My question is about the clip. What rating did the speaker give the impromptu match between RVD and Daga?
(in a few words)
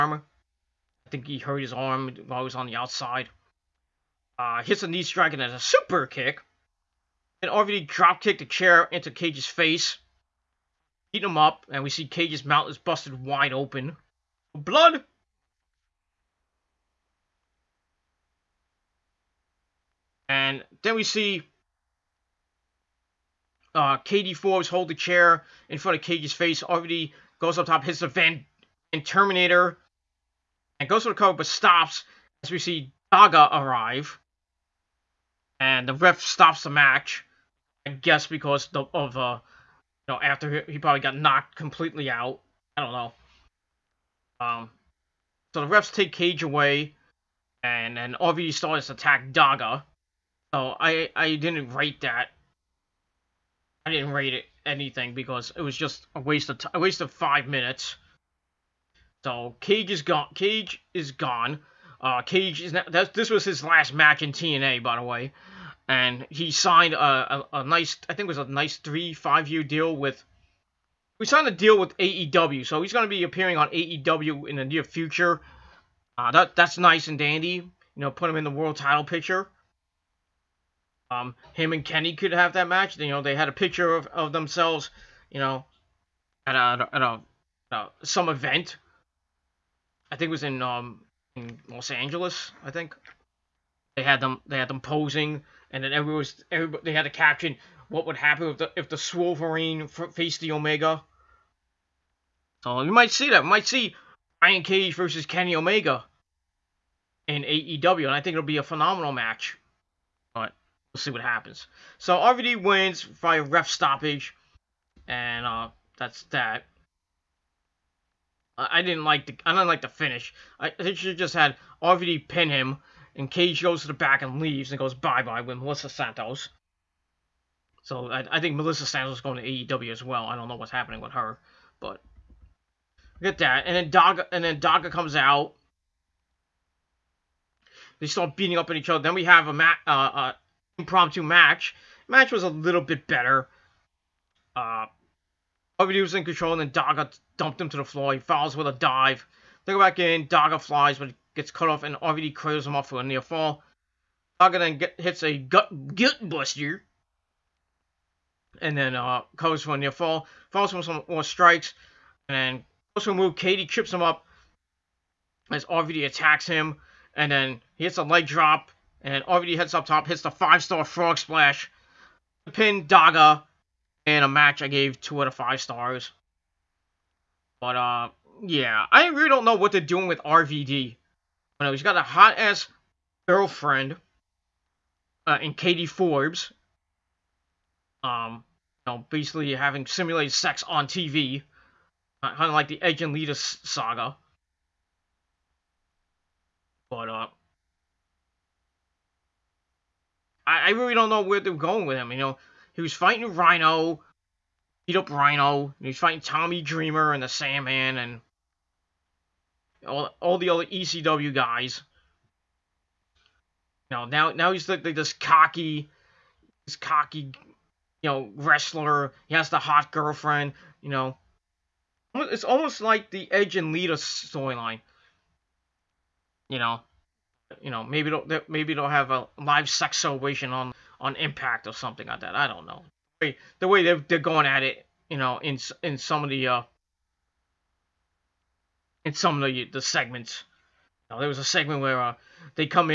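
2 out of 5 stars.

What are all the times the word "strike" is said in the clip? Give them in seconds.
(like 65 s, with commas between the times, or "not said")
5 s, 161 s.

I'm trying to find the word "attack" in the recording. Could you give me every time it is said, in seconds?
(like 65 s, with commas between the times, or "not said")
48 s, 166 s.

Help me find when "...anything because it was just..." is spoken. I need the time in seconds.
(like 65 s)
54 s.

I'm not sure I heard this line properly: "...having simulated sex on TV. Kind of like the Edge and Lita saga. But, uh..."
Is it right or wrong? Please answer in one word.
right.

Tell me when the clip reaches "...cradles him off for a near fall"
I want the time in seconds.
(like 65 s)
152 s.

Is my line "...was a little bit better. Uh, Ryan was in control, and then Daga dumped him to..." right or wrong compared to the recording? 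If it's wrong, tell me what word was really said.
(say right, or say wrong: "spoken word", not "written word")
wrong: "RVD", not "Ryan".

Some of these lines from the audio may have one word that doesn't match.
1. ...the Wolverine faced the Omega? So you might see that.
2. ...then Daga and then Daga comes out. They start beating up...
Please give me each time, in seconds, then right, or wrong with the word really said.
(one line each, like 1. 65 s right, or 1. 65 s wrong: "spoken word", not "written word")
1. 98 s right
2. 133 s right.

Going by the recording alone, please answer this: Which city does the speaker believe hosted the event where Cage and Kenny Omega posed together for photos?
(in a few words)
Los Angeles.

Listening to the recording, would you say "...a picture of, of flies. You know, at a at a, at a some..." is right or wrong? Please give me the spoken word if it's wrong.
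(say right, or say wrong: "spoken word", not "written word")
wrong: "themselves", not "flies".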